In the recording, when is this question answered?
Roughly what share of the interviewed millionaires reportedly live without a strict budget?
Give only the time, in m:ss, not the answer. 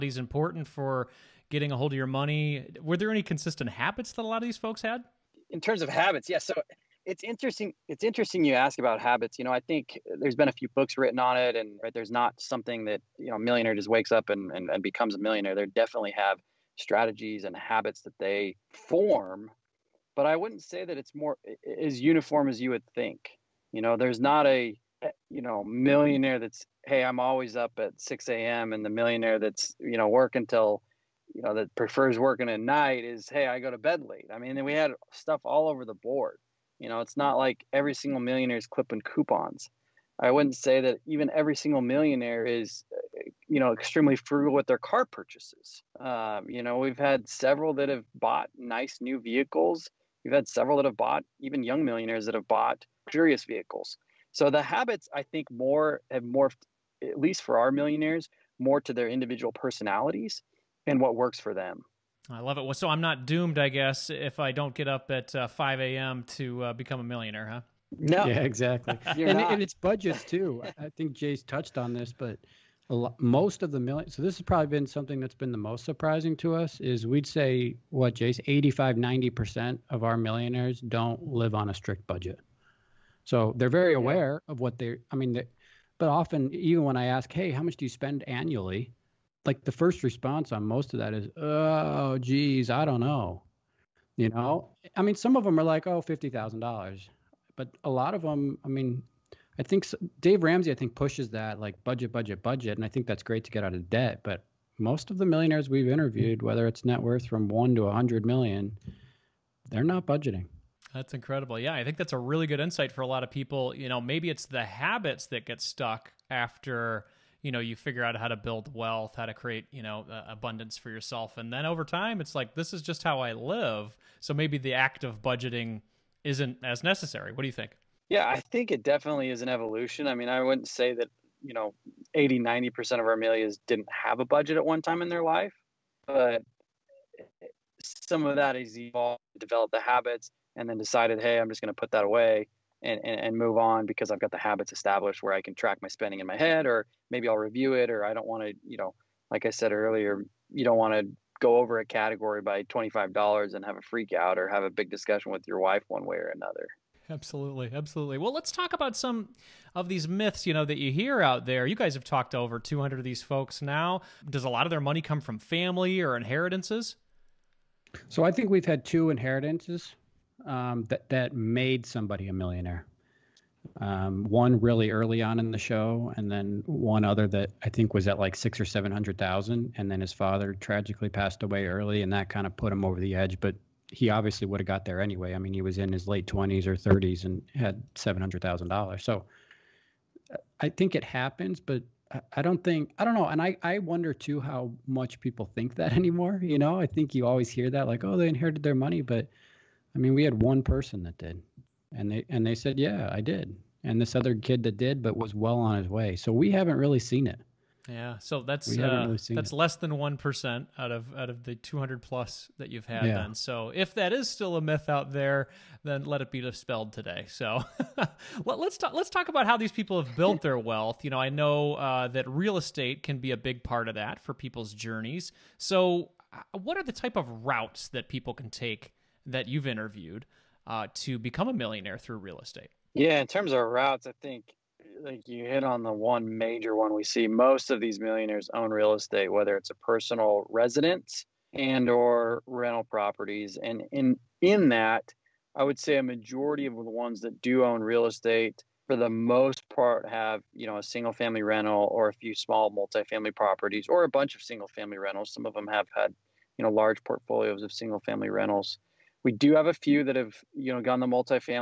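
1:18.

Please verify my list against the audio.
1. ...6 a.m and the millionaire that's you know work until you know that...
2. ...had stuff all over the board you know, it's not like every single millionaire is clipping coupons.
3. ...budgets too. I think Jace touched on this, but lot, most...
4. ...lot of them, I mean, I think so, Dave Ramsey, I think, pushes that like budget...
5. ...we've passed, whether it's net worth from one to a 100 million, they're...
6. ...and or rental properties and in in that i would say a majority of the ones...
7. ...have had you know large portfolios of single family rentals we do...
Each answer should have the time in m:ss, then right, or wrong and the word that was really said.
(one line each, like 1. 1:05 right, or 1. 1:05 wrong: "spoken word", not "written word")
1. 0:27 right
2. 0:34 right
3. 1:09 right
4. 1:37 right
5. 1:45 wrong: "interviewed", not "passed"
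6. 4:01 right
7. 4:15 right.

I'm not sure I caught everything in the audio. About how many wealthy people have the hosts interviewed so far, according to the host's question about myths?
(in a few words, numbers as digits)
over 200.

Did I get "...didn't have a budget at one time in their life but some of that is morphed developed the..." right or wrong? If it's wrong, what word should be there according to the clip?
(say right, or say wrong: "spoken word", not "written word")
wrong: "evolved", not "morphed".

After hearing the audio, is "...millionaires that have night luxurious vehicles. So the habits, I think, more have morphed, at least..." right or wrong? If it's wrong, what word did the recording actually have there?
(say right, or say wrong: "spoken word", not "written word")
wrong: "bought", not "night".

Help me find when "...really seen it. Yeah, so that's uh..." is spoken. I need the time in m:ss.
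3:26.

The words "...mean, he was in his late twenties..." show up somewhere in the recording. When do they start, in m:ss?
3:05.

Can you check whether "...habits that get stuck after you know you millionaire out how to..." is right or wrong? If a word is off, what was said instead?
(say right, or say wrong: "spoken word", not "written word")
wrong: "figure", not "millionaire".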